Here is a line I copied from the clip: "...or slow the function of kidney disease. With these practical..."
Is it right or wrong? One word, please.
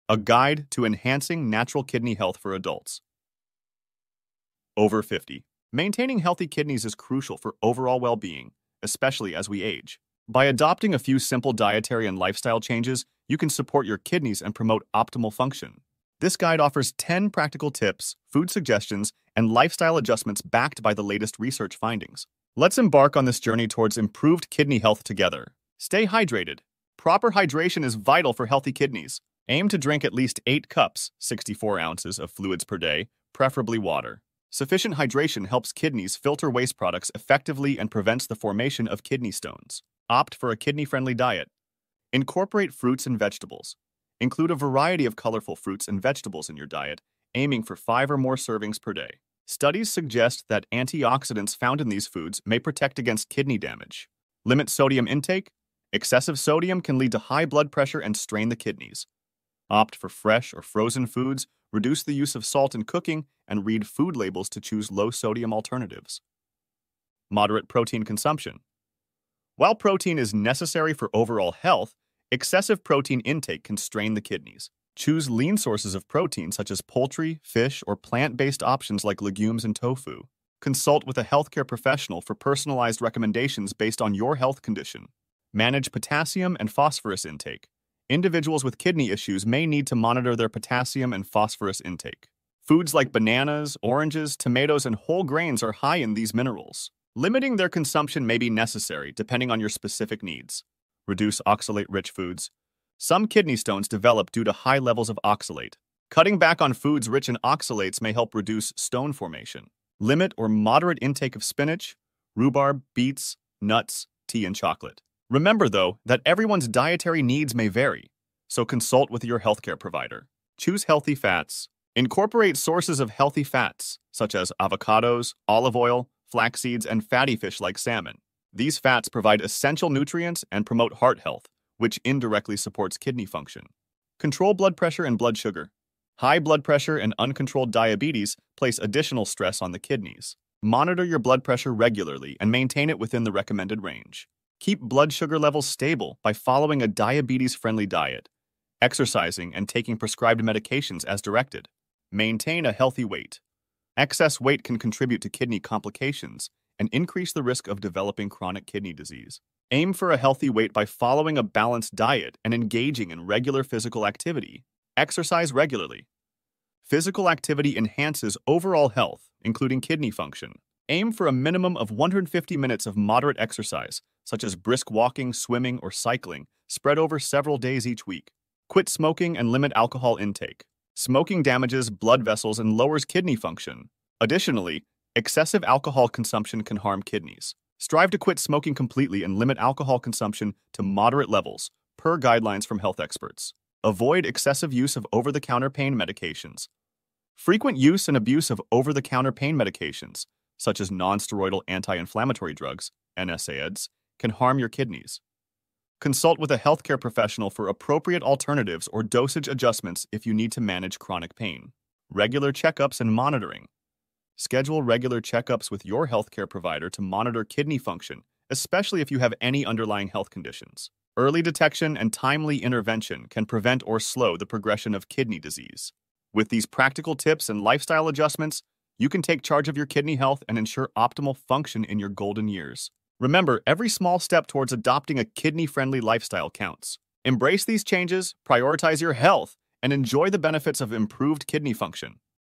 wrong.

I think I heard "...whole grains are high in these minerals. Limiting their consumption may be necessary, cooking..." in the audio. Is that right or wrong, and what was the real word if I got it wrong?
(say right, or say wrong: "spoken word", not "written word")
wrong: "depending", not "cooking".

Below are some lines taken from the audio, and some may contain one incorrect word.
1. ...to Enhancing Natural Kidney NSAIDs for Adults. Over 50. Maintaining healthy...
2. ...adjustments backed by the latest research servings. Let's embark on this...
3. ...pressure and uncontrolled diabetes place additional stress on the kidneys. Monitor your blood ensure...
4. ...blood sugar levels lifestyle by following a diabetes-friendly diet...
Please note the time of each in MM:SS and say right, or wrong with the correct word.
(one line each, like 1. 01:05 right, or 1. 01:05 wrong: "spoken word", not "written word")
1. 00:00 wrong: "Health", not "NSAIDs"
2. 00:19 wrong: "findings", not "servings"
3. 02:16 wrong: "pressure", not "ensure"
4. 02:24 wrong: "stable", not "lifestyle".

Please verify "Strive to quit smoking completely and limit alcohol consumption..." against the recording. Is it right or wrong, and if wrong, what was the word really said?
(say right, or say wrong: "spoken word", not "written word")
right.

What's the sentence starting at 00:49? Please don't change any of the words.
Studies suggest that antioxidants found in these foods may protect against kidney damage.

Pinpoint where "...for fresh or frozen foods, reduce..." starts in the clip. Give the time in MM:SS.
00:59.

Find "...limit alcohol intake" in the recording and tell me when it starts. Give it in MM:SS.
02:59.